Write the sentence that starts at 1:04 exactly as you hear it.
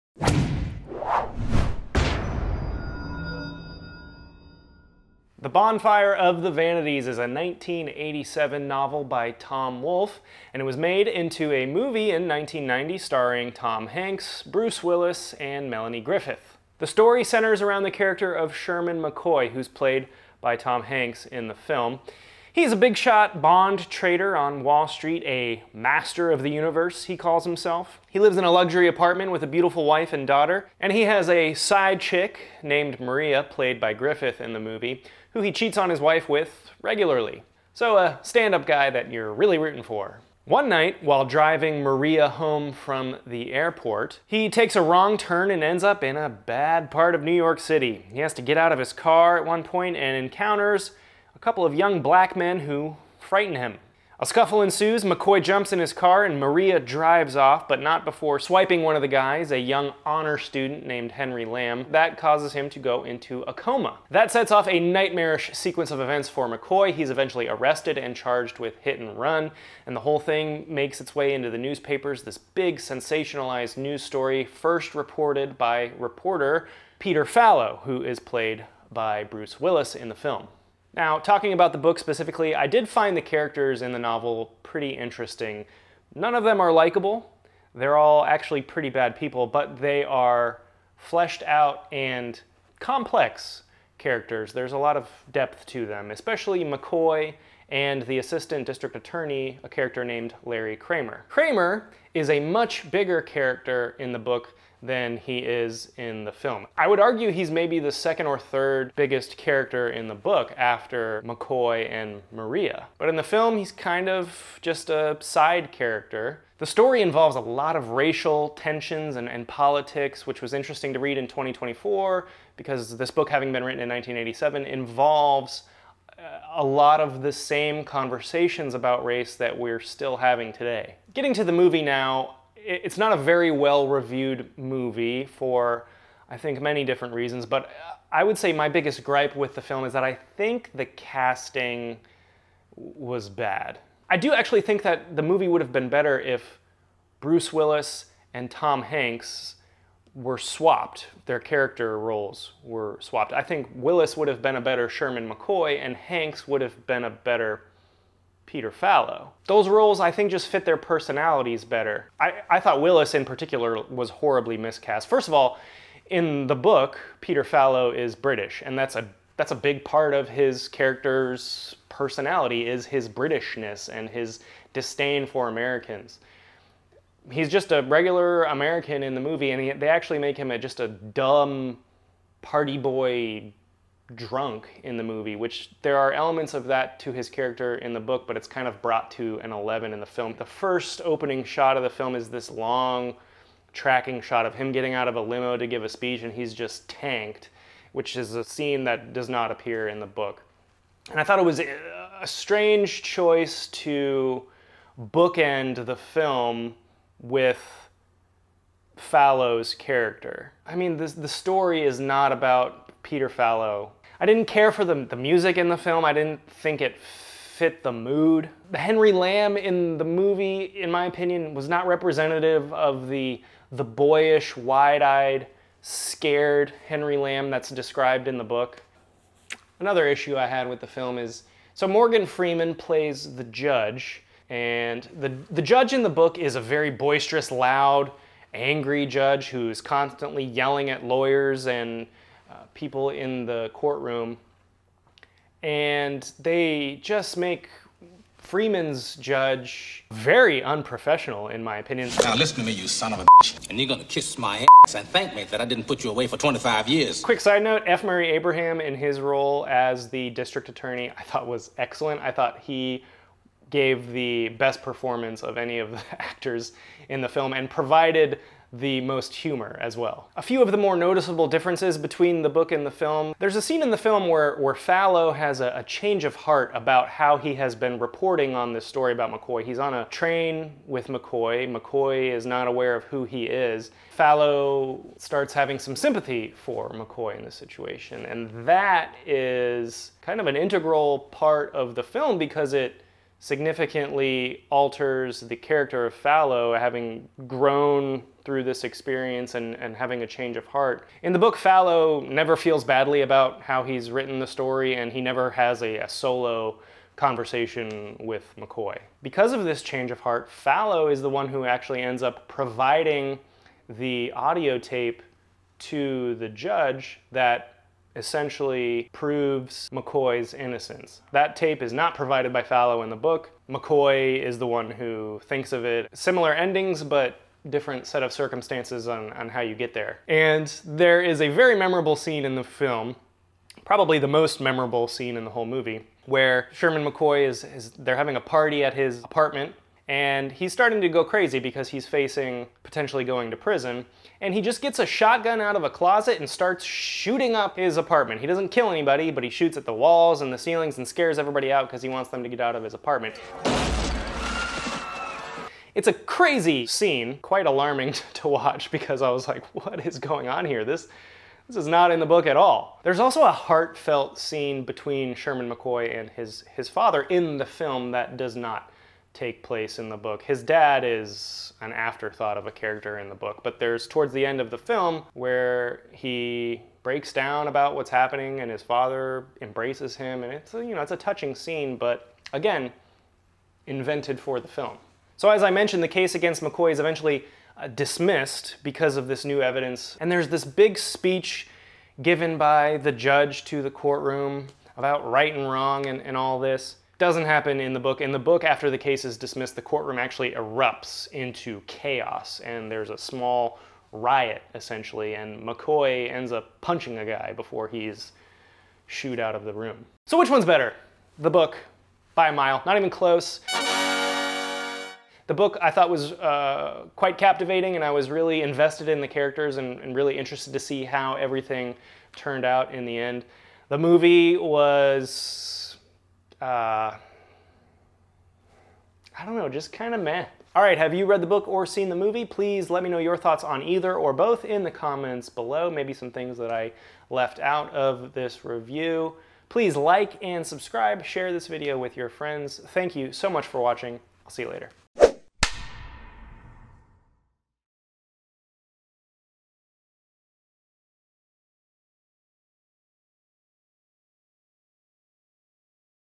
That sets off a nightmarish sequence of events for McCoy.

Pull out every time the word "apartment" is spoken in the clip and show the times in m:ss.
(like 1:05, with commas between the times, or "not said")
0:28, 5:39, 5:47, 5:52.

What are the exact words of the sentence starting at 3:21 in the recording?
And I thought it was a strange choice to bookend the film with Fallow's character.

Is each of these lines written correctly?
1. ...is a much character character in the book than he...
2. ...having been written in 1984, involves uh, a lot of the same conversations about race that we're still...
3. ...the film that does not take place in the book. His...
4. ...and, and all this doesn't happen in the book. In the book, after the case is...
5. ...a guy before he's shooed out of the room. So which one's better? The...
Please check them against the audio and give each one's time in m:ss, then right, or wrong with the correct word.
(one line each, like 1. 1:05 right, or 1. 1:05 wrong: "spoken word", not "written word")
1. 1:42 wrong: "bigger", not "character"
2. 2:03 wrong: "1987", not "1984"
3. 6:07 right
4. 6:36 right
5. 6:47 right.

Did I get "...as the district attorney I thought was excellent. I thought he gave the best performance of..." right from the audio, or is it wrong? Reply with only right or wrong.
right.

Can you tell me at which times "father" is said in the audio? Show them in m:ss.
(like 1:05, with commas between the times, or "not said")
6:06, 6:18.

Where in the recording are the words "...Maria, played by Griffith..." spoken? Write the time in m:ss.
0:32.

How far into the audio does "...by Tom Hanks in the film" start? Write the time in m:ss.
0:20.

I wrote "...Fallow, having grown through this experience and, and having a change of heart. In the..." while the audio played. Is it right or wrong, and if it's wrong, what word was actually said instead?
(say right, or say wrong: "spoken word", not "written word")
right.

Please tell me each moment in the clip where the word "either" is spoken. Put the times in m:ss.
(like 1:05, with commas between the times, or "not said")
7:13.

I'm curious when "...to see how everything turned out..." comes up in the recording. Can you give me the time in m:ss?
7:00.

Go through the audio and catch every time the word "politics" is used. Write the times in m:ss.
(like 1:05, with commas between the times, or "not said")
1:59.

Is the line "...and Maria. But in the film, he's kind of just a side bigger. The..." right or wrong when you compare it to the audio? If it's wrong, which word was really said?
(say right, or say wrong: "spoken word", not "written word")
wrong: "character", not "bigger".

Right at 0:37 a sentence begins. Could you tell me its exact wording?
So a stand-up guy that you're really rooting for.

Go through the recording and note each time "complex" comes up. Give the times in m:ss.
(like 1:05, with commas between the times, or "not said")
1:32.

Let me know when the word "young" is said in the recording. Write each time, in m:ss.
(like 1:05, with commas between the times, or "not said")
0:51, 0:59.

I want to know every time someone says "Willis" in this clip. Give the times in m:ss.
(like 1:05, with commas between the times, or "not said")
0:14, 1:19, 2:27, 2:33, 2:42.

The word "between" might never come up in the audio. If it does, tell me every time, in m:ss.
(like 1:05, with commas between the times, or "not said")
4:31, 6:04.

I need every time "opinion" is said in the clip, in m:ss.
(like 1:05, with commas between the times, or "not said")
3:41, 4:11.